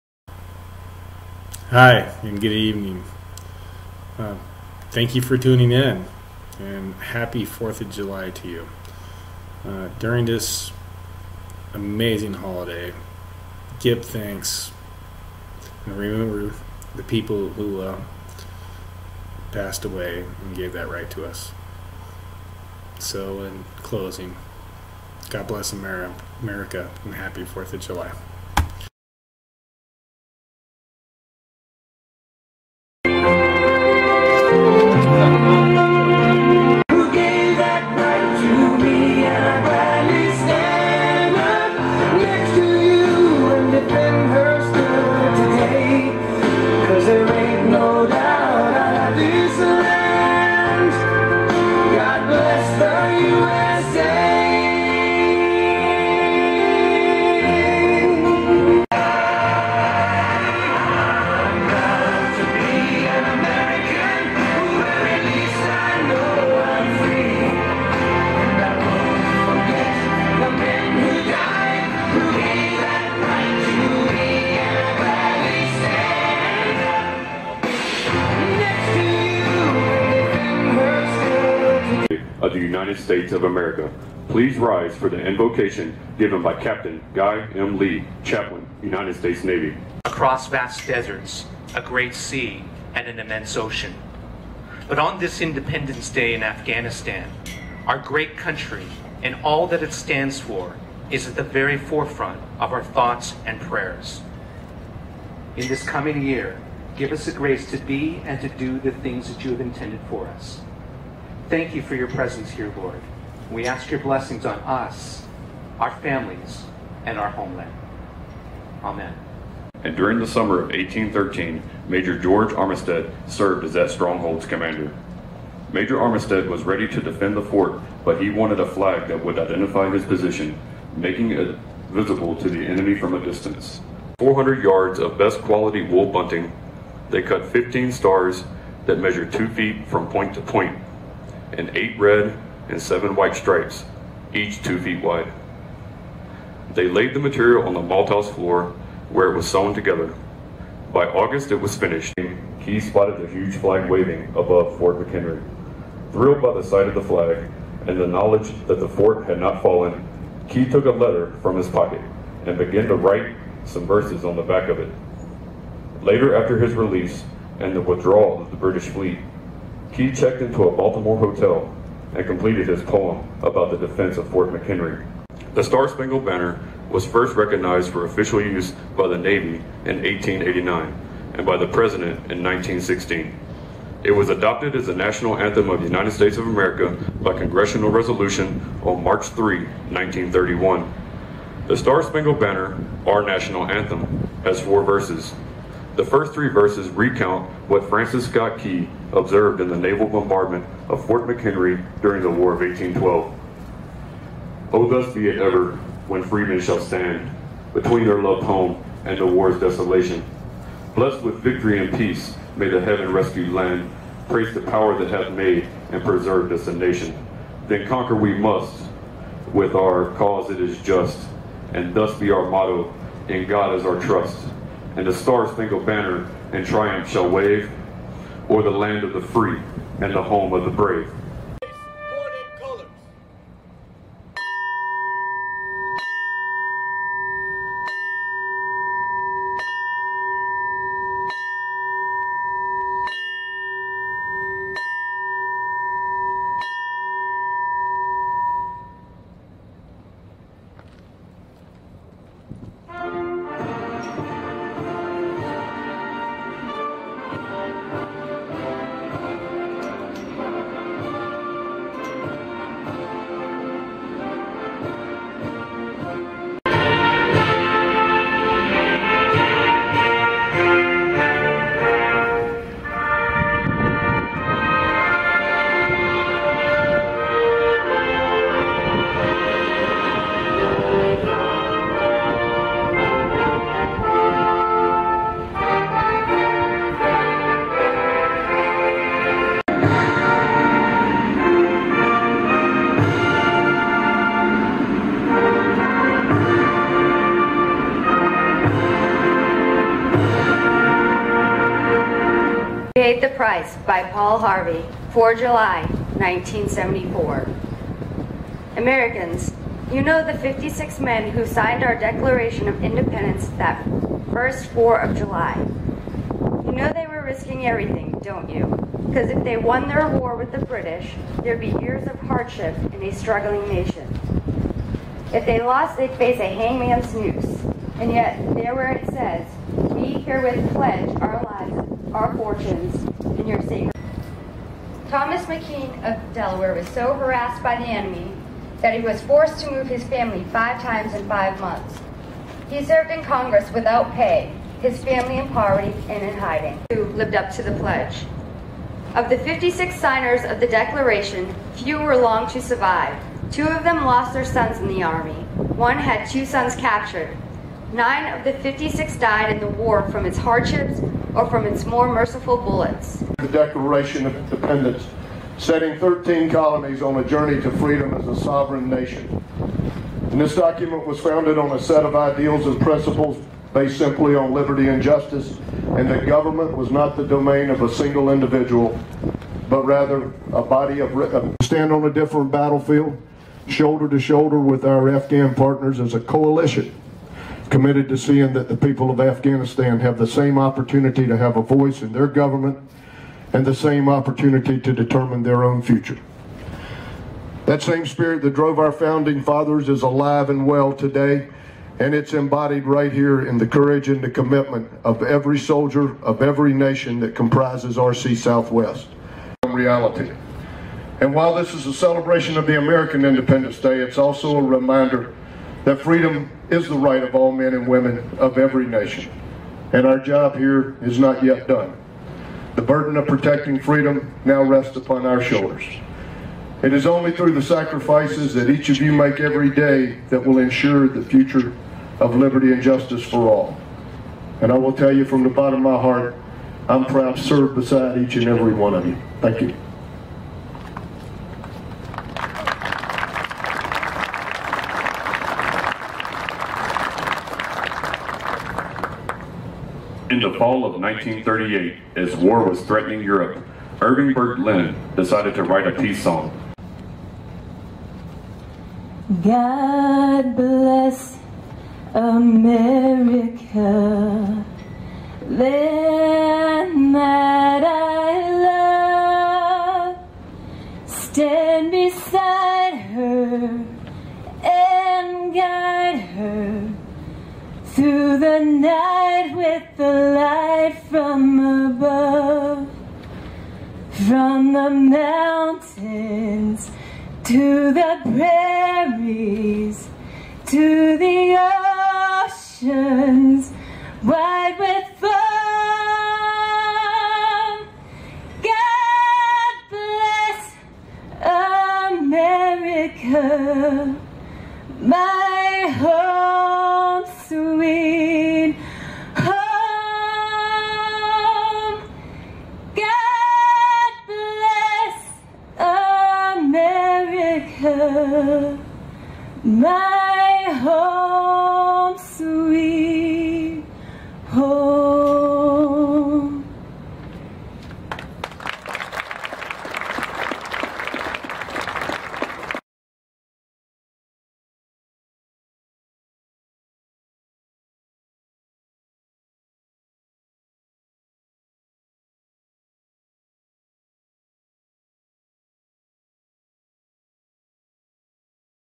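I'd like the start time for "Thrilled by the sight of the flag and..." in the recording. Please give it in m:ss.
2:36.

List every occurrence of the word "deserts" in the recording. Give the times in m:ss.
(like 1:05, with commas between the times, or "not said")
1:30.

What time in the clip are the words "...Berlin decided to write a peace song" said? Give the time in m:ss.
7:34.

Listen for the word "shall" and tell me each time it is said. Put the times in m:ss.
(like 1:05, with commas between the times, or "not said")
3:26, 3:47.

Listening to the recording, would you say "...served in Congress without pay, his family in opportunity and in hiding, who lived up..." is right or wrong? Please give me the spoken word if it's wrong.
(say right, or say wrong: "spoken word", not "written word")
wrong: "poverty", not "opportunity".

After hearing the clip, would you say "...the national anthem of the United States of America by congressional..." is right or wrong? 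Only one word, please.
right.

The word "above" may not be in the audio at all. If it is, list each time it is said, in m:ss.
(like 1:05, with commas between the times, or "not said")
2:34, 8:01.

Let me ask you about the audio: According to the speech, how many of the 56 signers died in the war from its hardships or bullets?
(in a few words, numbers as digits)
9.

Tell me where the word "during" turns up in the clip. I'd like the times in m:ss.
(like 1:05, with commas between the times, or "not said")
0:09, 1:59, 3:22.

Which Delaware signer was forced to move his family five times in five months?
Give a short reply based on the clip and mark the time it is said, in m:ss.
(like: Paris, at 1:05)
Thomas McKean, at 5:35.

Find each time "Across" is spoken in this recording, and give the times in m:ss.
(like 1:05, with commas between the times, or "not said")
1:30.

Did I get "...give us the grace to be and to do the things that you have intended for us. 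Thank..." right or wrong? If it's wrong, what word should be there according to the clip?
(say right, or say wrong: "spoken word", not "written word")
right.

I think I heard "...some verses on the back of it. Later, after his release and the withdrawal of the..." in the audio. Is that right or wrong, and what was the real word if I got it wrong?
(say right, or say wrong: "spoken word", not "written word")
right.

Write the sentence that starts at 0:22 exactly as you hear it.
So, in closing, God bless America and happy 4th of July.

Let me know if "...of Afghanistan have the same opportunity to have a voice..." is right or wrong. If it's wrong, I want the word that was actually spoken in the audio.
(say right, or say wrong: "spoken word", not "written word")
right.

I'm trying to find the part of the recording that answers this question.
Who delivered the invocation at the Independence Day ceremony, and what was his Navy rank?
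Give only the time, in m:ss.
1:26.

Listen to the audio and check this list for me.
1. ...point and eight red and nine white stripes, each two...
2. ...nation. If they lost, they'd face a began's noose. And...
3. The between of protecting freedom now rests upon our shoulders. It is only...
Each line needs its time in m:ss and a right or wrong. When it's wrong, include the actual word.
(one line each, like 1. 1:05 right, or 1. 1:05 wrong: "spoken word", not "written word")
1. 2:20 wrong: "seven", not "nine"
2. 5:23 wrong: "hangman", not "began"
3. 7:02 wrong: "burden", not "between".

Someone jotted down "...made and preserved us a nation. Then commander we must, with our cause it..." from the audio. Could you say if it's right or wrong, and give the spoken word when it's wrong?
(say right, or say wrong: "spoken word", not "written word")
wrong: "conquer", not "commander".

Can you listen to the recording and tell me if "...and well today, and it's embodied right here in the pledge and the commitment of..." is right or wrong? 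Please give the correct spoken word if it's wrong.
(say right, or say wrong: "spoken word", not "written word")
wrong: "courage", not "pledge".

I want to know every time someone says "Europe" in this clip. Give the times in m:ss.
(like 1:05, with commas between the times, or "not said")
7:33.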